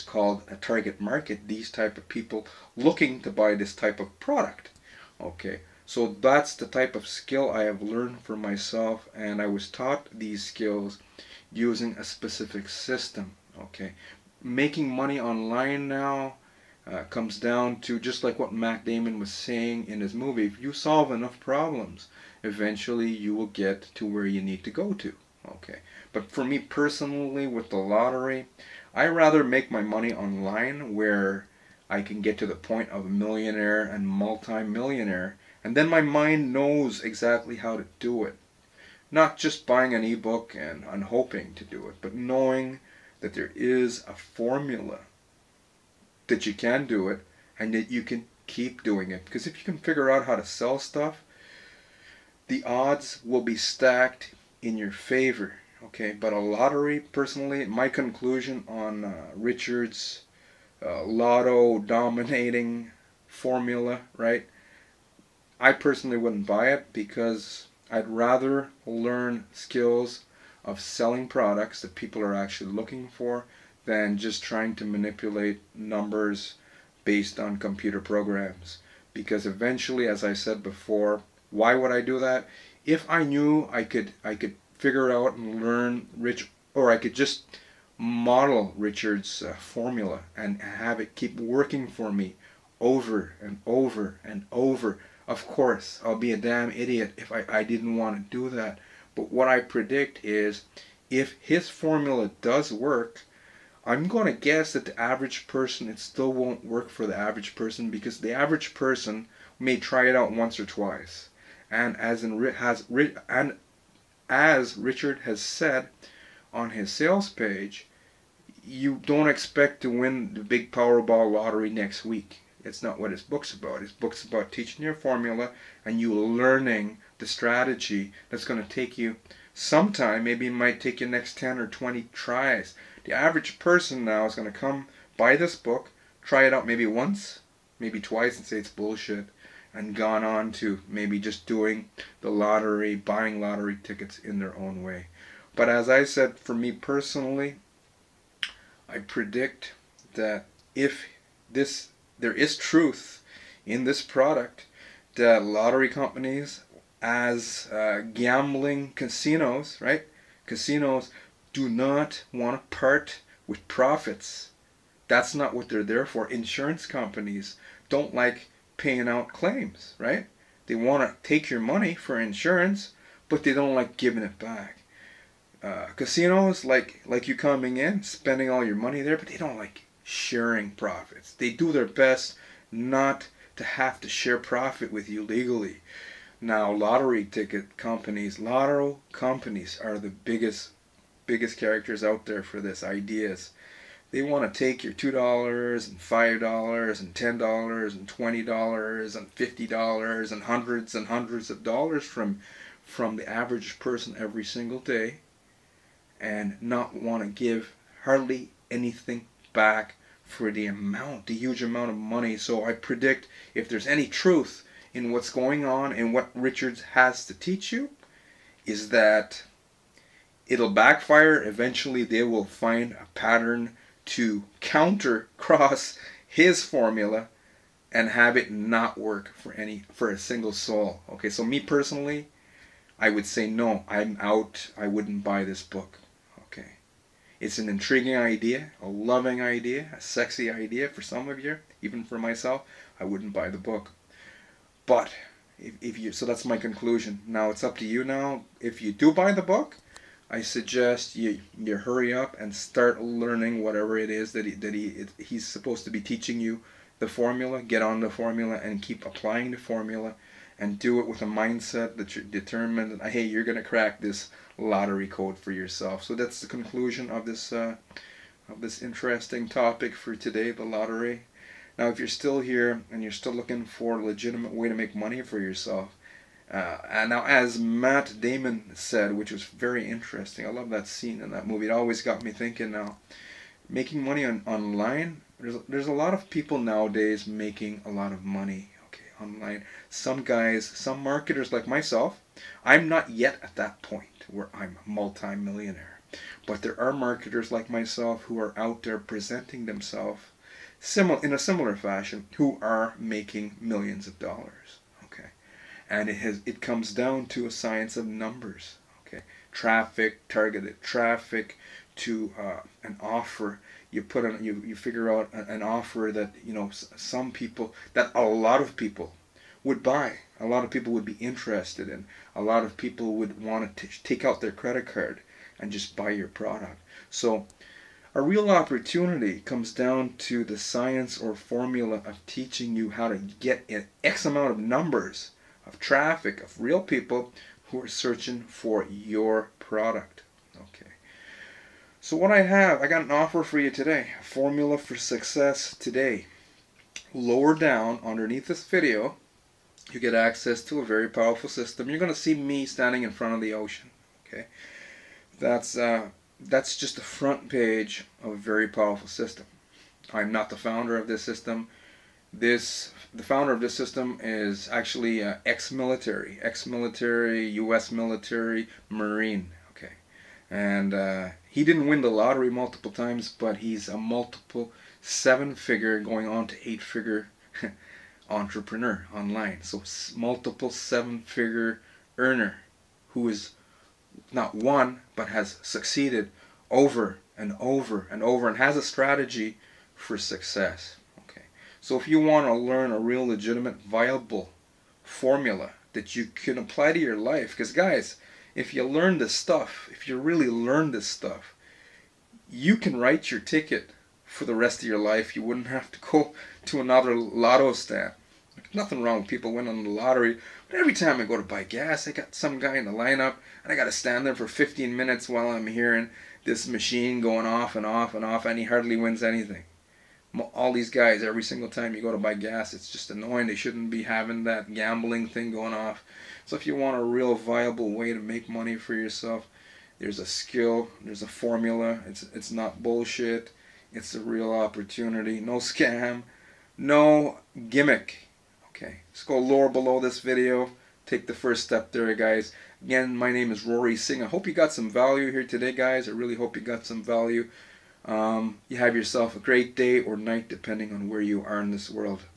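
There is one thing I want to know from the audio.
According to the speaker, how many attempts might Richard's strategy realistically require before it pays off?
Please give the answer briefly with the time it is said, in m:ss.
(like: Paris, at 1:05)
10 or 20, at 2:11.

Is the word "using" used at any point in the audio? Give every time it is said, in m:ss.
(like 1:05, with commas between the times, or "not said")
0:11.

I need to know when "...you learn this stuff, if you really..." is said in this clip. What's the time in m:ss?
6:38.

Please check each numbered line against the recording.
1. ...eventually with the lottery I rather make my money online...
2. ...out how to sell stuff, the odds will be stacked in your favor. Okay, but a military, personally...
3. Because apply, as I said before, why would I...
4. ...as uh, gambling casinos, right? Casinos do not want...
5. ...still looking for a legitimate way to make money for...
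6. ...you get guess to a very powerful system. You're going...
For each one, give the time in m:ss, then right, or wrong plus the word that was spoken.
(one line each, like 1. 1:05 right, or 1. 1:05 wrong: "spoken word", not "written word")
1. 0:26 wrong: "personally", not "eventually"
2. 0:50 wrong: "lottery", not "military"
3. 1:19 wrong: "eventually", not "apply"
4. 2:37 right
5. 4:33 right
6. 5:49 wrong: "access", not "guess".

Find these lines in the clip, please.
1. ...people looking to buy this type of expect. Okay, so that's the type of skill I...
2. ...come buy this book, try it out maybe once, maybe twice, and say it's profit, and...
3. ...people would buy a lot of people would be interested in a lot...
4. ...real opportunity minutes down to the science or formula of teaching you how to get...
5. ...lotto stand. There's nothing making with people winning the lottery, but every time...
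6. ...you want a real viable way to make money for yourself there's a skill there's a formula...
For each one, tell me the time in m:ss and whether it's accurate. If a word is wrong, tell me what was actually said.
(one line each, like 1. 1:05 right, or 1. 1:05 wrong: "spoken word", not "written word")
1. 0:02 wrong: "product", not "expect"
2. 2:14 wrong: "bullshit", not "profit"
3. 5:18 right
4. 5:28 wrong: "comes", not "minutes"
5. 6:47 wrong: "wrong", not "making"
6. 7:06 right.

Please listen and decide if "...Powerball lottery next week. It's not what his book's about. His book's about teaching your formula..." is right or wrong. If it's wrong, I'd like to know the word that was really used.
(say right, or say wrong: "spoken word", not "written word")
right.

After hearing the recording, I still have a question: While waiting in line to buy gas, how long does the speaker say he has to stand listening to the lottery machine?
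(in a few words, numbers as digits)
15 minutes.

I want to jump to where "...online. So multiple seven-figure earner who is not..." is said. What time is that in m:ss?
6:19.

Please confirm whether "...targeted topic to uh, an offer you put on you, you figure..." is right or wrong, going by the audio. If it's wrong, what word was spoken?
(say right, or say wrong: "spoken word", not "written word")
wrong: "traffic", not "topic".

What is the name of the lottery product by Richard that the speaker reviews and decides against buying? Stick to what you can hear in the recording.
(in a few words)
lotto dominating formula.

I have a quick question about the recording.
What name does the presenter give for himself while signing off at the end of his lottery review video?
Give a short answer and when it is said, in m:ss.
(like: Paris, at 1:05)
Rory Singh, at 7:23.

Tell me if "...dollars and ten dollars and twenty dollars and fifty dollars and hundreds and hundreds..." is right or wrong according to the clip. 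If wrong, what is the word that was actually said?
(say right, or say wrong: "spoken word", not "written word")
right.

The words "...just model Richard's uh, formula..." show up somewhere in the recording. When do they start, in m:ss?
1:27.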